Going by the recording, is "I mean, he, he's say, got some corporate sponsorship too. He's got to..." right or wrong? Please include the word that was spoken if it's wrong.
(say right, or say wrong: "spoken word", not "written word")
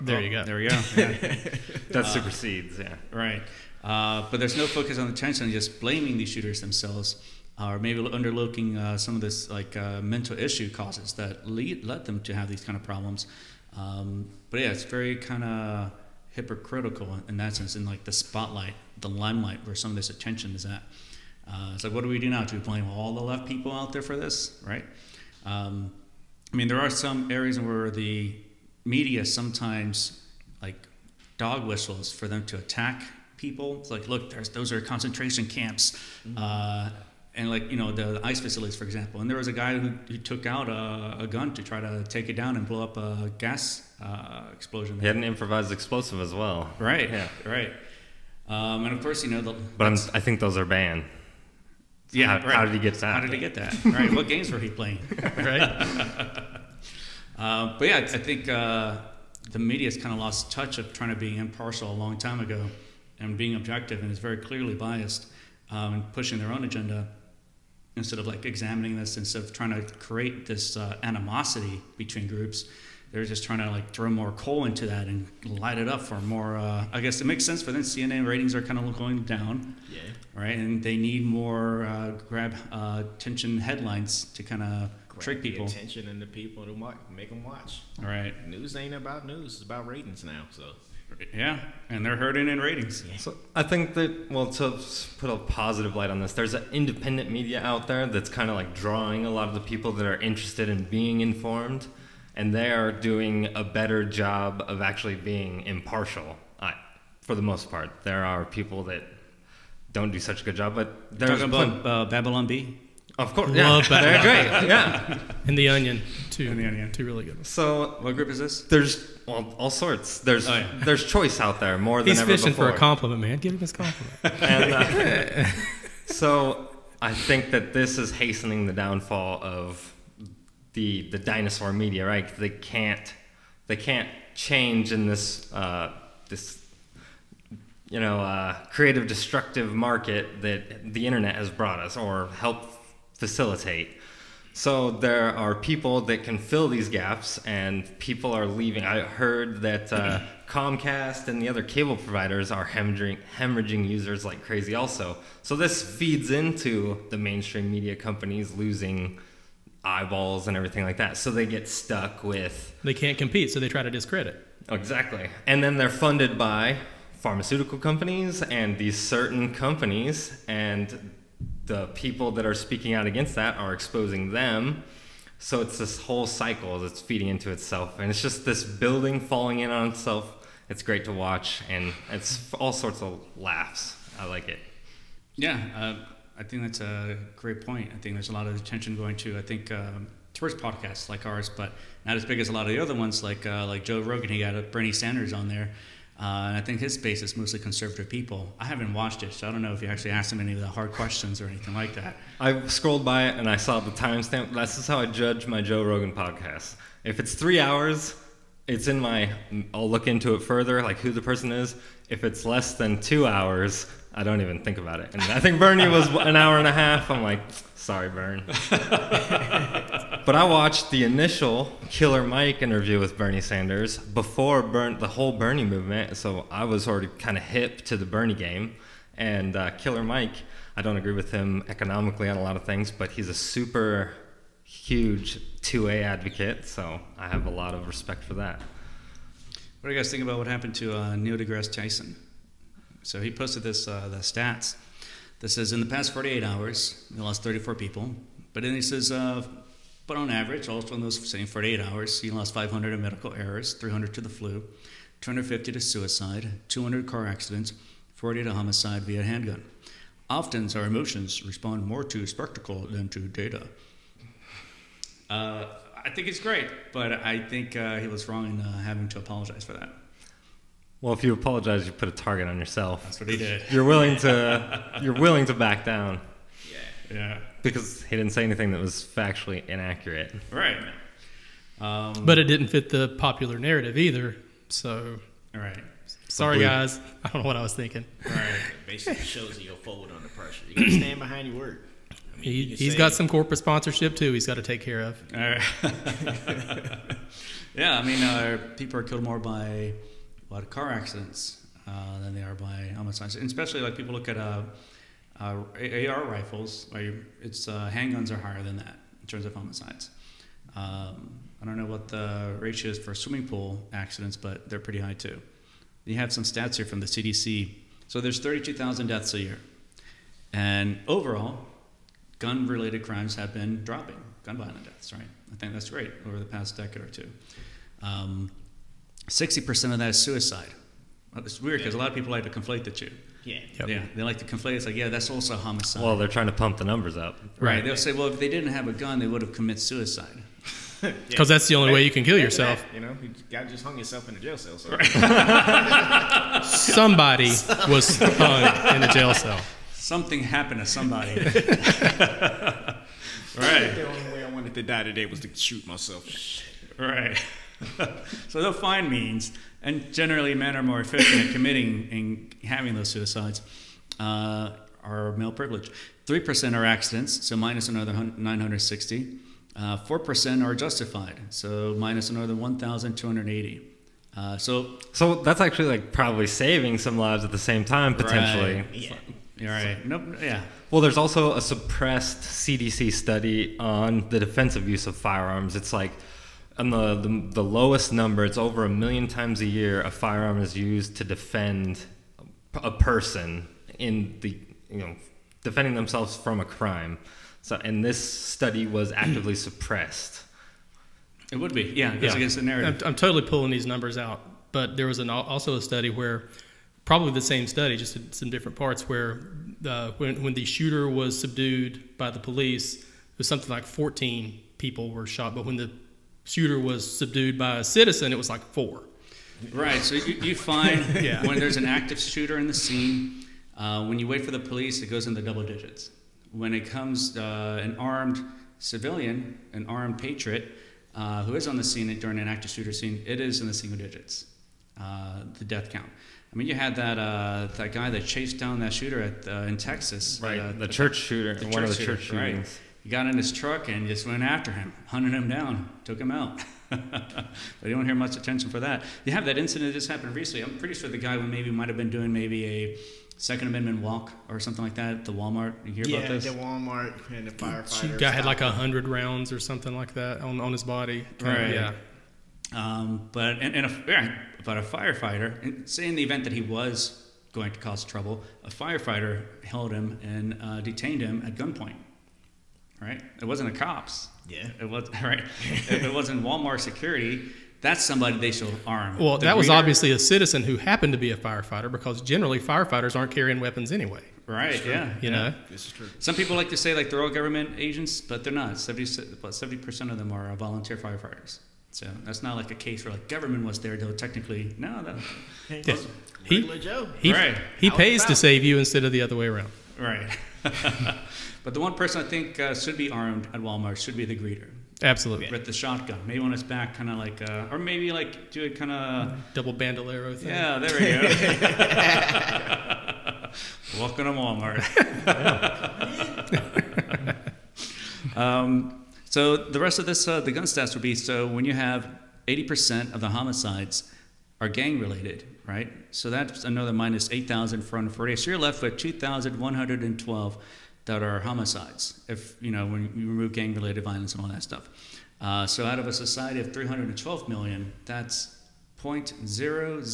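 right.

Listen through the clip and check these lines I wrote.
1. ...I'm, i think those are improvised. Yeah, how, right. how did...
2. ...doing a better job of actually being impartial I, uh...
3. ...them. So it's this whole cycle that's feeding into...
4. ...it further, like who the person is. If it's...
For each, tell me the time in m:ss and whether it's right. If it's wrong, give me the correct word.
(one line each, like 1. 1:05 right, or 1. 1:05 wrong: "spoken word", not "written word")
1. 0:49 wrong: "banned", not "improvised"
2. 1:42 right
3. 2:54 right
4. 3:30 right.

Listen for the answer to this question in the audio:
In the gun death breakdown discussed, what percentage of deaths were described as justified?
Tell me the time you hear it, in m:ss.
6:09.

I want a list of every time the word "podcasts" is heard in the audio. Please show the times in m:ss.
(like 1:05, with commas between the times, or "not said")
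3:10, 3:26.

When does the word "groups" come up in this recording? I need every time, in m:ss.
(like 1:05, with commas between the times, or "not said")
1:12, 1:58.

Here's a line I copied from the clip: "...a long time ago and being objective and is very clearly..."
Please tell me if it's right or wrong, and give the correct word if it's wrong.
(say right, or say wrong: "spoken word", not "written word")
right.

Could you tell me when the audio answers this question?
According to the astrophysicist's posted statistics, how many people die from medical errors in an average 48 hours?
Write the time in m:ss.
4:12.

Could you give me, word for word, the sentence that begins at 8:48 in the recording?
So you're left with 2,112 that are homicides, if, you know, when you remove gang-related violence and all that stuff.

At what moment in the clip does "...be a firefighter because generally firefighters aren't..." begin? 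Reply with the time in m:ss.
8:01.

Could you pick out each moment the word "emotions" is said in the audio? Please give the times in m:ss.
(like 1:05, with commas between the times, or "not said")
4:20.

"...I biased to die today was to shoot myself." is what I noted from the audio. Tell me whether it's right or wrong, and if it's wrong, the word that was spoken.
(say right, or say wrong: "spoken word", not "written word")
wrong: "wanted", not "biased".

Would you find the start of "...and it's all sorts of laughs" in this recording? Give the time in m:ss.
3:01.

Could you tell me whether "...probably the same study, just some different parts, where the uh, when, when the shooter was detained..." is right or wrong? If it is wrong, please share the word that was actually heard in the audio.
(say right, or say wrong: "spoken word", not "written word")
wrong: "subdued", not "detained".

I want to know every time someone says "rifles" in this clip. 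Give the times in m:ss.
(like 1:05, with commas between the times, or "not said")
5:06.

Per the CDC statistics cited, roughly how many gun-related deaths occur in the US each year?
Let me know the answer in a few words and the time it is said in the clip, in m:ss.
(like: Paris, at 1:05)
32,000, at 5:18.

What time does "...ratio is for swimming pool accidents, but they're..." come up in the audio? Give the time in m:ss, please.
5:12.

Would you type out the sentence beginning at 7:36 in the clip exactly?
Yeah, the Walmart and the firefighter.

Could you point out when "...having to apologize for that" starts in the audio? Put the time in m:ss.
4:28.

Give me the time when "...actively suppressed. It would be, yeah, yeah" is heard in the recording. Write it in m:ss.
6:39.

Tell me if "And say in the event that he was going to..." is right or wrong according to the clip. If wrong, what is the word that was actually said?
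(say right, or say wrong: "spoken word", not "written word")
right.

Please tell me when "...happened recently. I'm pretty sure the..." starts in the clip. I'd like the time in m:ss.
7:30.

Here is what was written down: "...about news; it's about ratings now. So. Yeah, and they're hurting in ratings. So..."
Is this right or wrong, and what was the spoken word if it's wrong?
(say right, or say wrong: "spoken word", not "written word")
right.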